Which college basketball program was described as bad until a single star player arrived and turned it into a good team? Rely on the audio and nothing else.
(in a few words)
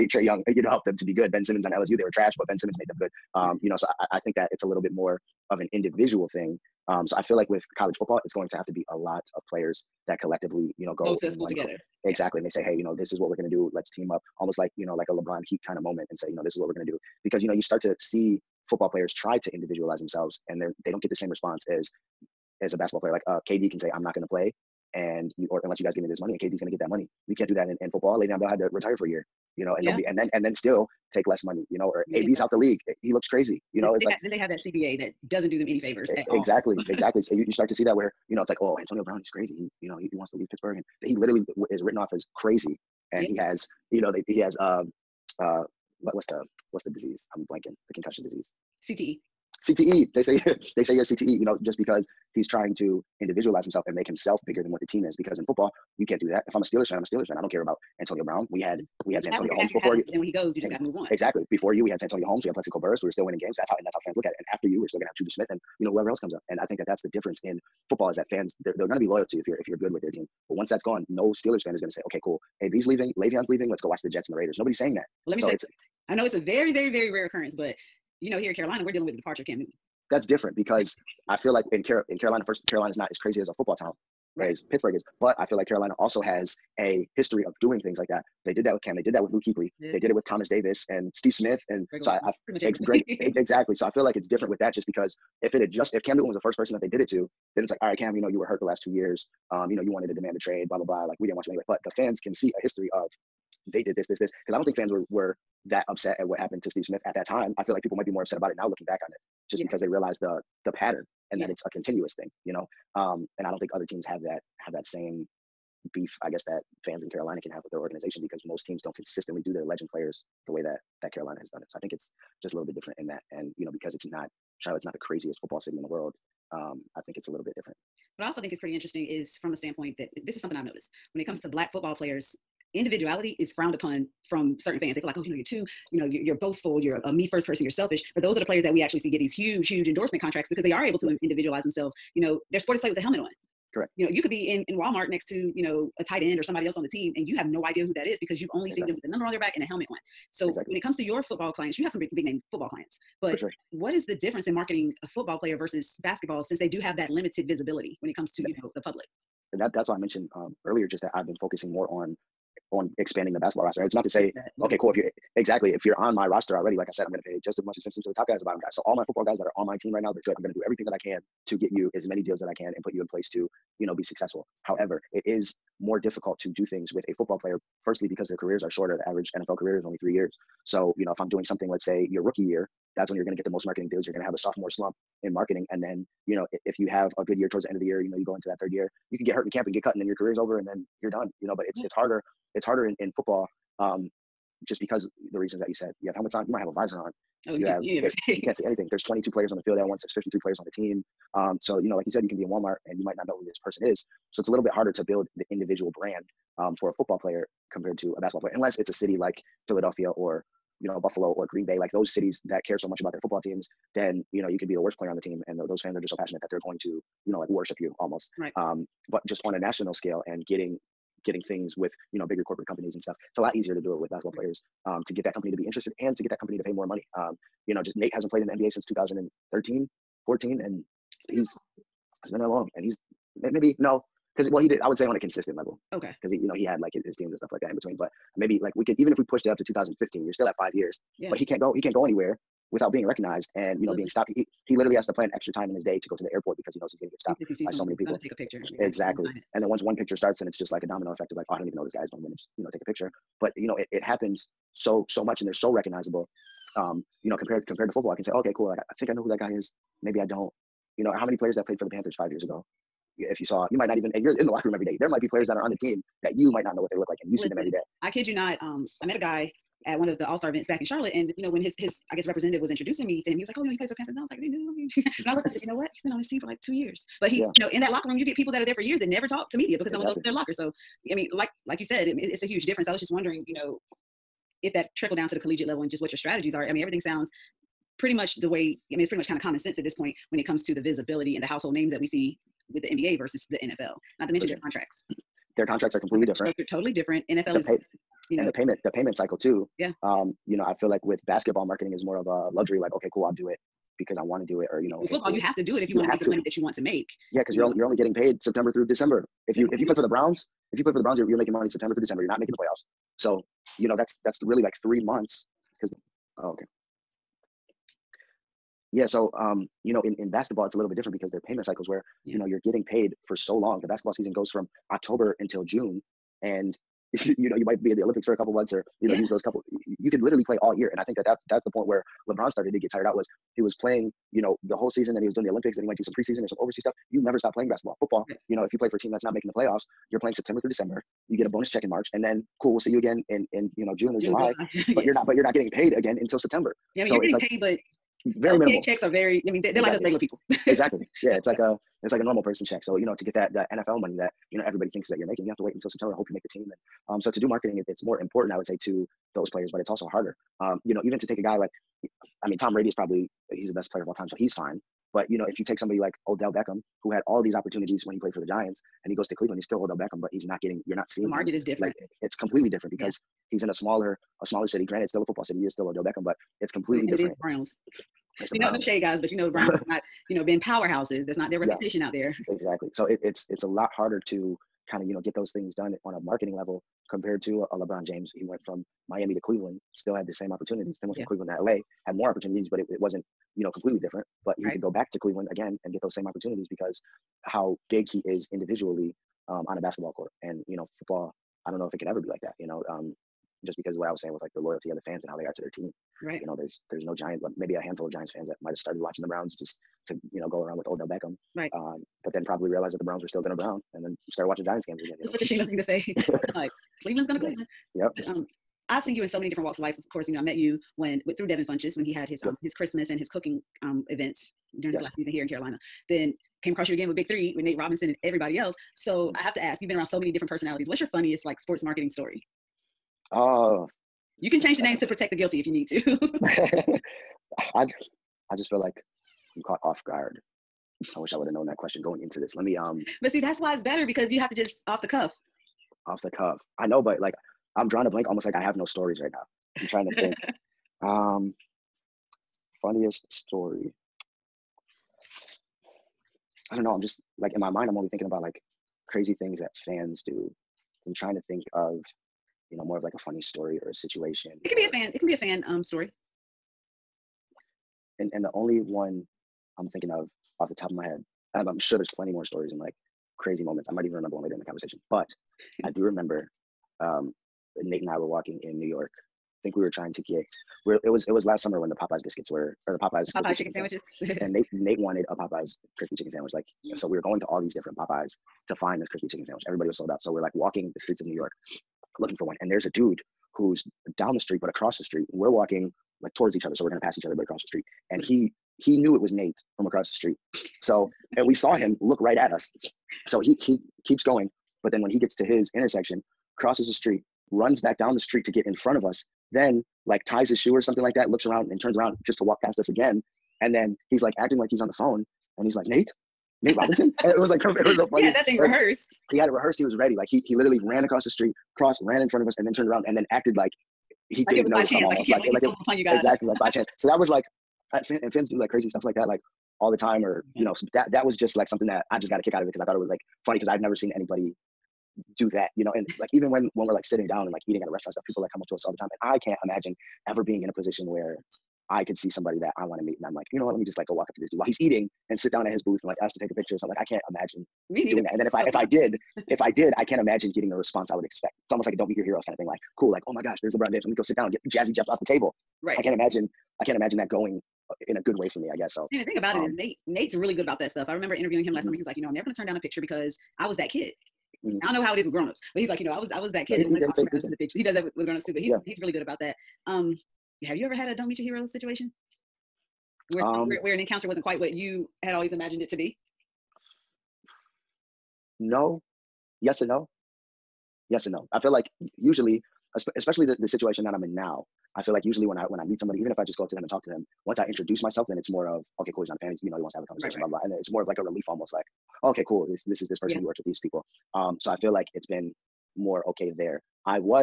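LSU.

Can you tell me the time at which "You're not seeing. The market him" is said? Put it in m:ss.
6:10.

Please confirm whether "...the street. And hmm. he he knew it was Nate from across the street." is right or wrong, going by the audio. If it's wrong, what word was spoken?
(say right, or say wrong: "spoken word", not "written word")
right.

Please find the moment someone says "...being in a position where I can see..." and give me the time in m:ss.
9:00.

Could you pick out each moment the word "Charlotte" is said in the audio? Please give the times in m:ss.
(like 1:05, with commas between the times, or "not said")
2:04, 4:30.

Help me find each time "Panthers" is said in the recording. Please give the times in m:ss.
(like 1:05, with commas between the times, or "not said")
4:21, 4:33.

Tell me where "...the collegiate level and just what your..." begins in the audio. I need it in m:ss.
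4:45.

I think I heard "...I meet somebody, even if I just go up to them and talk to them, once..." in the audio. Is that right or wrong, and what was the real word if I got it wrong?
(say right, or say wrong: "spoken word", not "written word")
right.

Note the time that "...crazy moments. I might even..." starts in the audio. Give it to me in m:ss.
7:53.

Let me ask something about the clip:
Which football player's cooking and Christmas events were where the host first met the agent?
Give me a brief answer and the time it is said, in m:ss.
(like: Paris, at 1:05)
Devin Funchess, at 7:01.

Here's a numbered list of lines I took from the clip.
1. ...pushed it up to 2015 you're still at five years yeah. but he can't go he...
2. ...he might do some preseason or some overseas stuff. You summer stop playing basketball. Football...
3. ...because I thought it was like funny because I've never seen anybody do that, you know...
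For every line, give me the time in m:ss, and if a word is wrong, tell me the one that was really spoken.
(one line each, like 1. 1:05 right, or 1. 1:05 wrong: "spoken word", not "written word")
1. 3:59 right
2. 5:35 wrong: "never", not "summer"
3. 8:52 right.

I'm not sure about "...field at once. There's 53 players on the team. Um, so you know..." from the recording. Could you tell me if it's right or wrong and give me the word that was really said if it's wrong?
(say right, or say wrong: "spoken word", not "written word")
right.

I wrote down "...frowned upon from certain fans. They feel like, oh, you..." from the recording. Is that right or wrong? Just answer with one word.
right.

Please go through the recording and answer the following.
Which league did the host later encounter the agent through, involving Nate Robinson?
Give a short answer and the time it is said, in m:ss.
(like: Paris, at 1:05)
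Big Three, at 7:07.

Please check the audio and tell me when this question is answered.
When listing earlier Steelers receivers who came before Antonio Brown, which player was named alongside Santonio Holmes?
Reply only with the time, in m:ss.
1:02.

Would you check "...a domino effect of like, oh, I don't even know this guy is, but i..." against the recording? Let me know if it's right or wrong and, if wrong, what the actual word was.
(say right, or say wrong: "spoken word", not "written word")
right.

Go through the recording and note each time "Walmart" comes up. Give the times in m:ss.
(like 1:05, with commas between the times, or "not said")
2:24, 3:22.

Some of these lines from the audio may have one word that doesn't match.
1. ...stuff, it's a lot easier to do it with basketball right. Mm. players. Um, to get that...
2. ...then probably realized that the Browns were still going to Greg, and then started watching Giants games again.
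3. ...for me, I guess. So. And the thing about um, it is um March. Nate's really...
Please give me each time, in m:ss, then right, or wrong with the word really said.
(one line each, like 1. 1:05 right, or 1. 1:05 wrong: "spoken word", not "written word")
1. 3:43 right
2. 6:52 wrong: "Brown", not "Greg"
3. 9:18 wrong: "Nate", not "March".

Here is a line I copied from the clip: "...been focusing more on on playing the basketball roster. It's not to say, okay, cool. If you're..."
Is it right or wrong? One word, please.
wrong.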